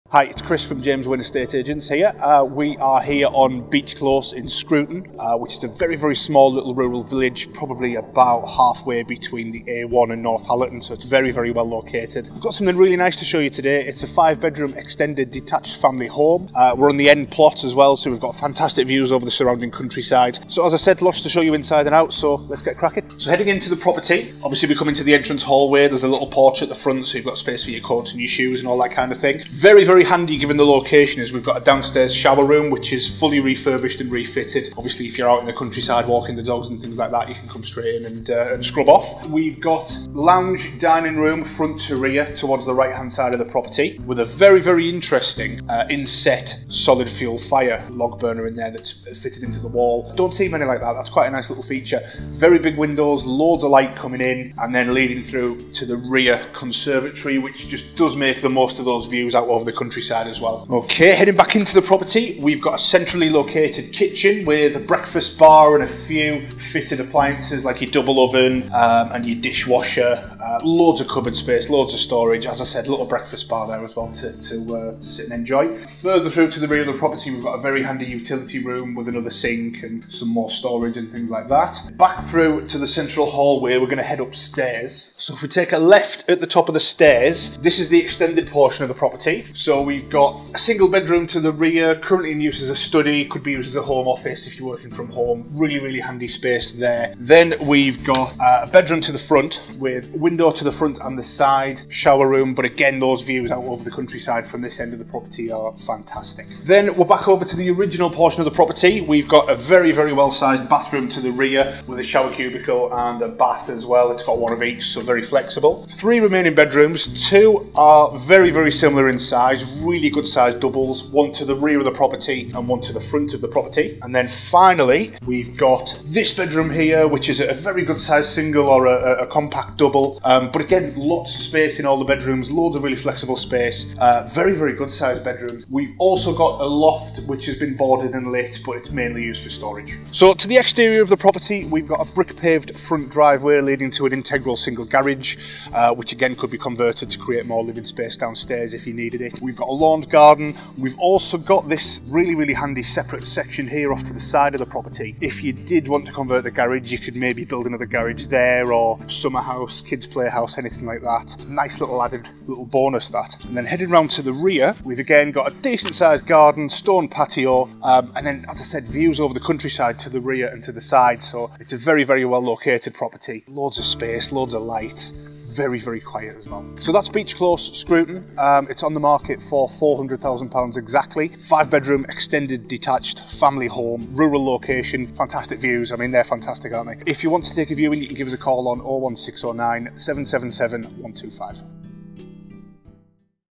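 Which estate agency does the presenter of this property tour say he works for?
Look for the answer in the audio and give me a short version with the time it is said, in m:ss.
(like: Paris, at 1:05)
James Winn Estate Agents, at 0:00.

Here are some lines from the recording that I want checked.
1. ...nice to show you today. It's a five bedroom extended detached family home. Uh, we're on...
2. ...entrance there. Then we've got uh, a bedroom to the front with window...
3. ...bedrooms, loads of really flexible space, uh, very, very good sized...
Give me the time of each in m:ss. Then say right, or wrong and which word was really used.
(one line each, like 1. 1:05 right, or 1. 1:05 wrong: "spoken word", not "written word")
1. 0:12 right
2. 1:36 wrong: "space", not "entrance"
3. 2:12 right.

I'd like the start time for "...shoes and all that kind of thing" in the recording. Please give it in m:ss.
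0:28.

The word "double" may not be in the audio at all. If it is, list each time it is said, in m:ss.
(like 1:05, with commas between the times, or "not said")
1:07, 2:00, 2:09.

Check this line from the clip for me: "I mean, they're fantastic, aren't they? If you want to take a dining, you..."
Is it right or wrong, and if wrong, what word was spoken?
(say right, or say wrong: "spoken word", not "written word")
wrong: "viewing", not "dining".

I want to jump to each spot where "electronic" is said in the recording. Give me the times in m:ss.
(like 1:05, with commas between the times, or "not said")
not said.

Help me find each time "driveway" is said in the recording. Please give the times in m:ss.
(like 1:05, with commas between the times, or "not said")
2:23.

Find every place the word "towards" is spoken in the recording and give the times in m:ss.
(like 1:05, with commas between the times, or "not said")
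0:42.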